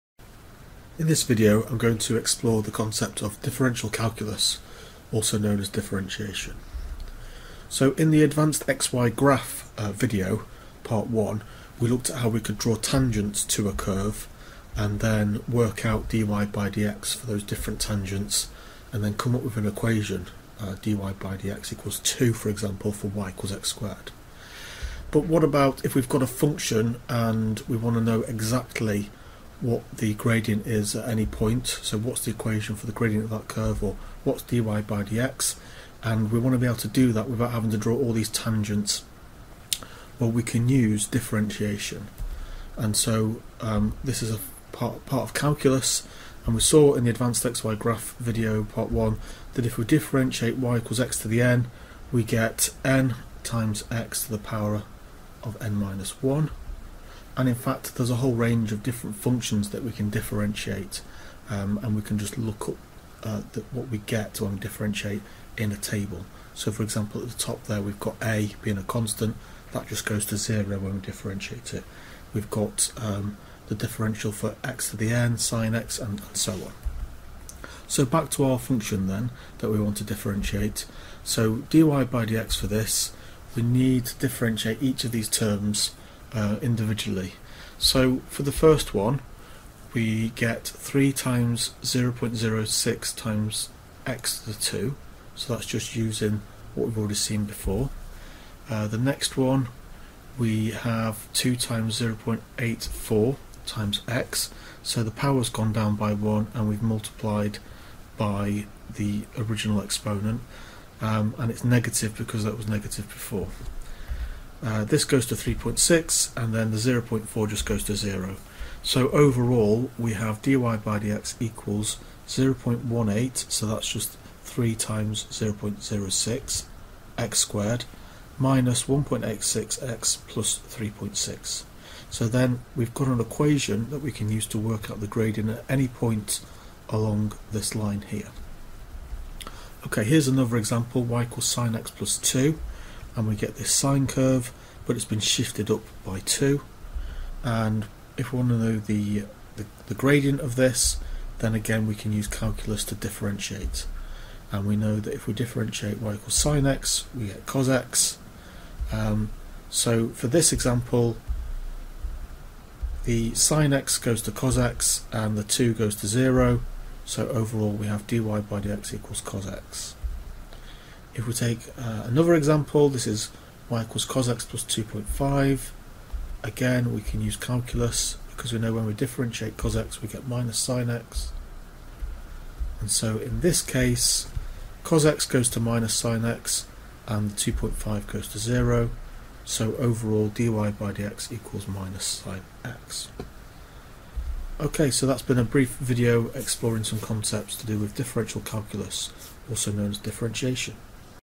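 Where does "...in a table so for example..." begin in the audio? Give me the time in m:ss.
1:05.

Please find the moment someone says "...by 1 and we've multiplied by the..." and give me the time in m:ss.
1:45.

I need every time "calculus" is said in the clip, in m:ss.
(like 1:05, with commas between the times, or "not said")
0:03, 0:45, 2:32, 2:57, 3:18.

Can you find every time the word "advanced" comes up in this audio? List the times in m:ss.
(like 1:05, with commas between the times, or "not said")
0:08, 0:47.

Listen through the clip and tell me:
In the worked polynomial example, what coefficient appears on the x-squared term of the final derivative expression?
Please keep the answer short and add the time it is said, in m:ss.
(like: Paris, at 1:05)
0.18, at 2:02.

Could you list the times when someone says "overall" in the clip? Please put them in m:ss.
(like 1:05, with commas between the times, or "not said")
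1:59, 2:47, 3:09.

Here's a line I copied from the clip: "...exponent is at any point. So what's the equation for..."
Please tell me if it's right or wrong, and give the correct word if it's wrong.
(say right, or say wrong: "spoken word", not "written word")
wrong: "gradient", not "exponent".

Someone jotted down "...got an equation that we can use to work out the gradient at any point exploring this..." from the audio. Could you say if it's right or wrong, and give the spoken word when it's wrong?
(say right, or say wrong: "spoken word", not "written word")
wrong: "along", not "exploring".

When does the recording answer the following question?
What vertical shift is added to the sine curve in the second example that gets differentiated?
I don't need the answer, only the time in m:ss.
2:21.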